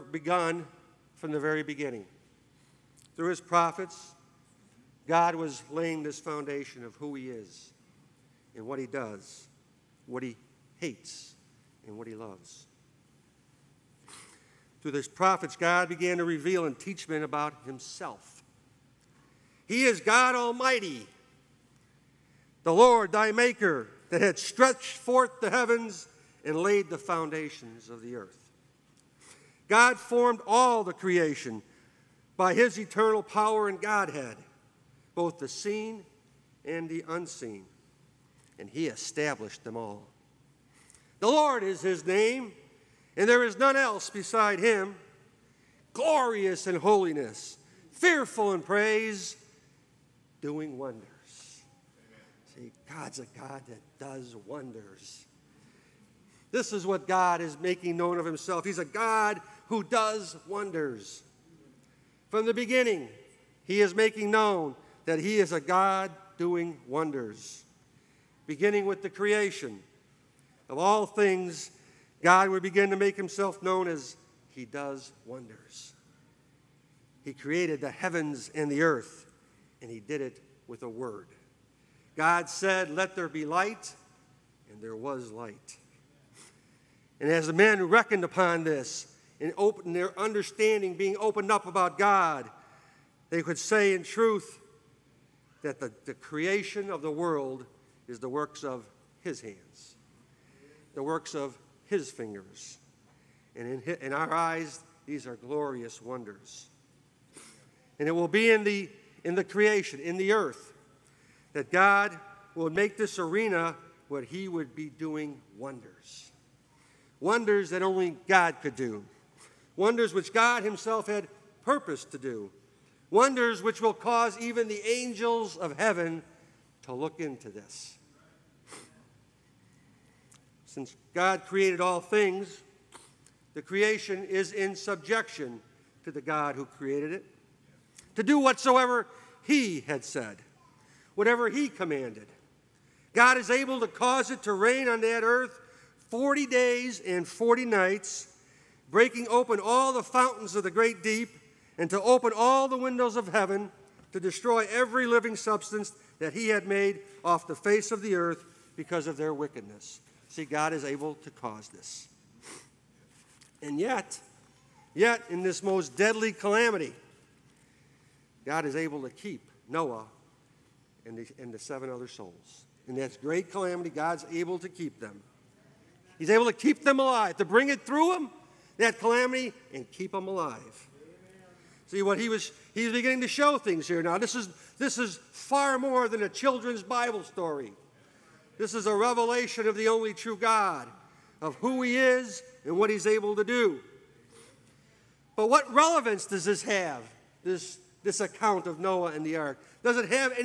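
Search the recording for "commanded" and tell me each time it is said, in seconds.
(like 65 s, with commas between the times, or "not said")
141 s.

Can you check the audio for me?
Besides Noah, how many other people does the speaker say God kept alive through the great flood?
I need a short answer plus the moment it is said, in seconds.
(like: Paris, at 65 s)
7, at 171 s.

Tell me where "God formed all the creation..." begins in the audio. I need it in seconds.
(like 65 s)
29 s.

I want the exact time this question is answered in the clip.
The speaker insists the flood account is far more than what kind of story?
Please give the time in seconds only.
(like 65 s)
186 s.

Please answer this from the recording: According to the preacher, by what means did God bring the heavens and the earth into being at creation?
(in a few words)
A word.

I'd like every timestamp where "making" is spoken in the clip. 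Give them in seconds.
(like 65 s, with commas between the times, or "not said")
57 s, 63 s.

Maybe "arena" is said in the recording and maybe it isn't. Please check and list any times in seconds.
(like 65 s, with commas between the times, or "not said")
113 s.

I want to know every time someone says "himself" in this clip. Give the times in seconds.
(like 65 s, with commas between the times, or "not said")
17 s, 58 s, 73 s, 120 s.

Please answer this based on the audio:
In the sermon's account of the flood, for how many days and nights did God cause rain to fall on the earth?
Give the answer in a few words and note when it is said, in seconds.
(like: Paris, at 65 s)
40, at 146 s.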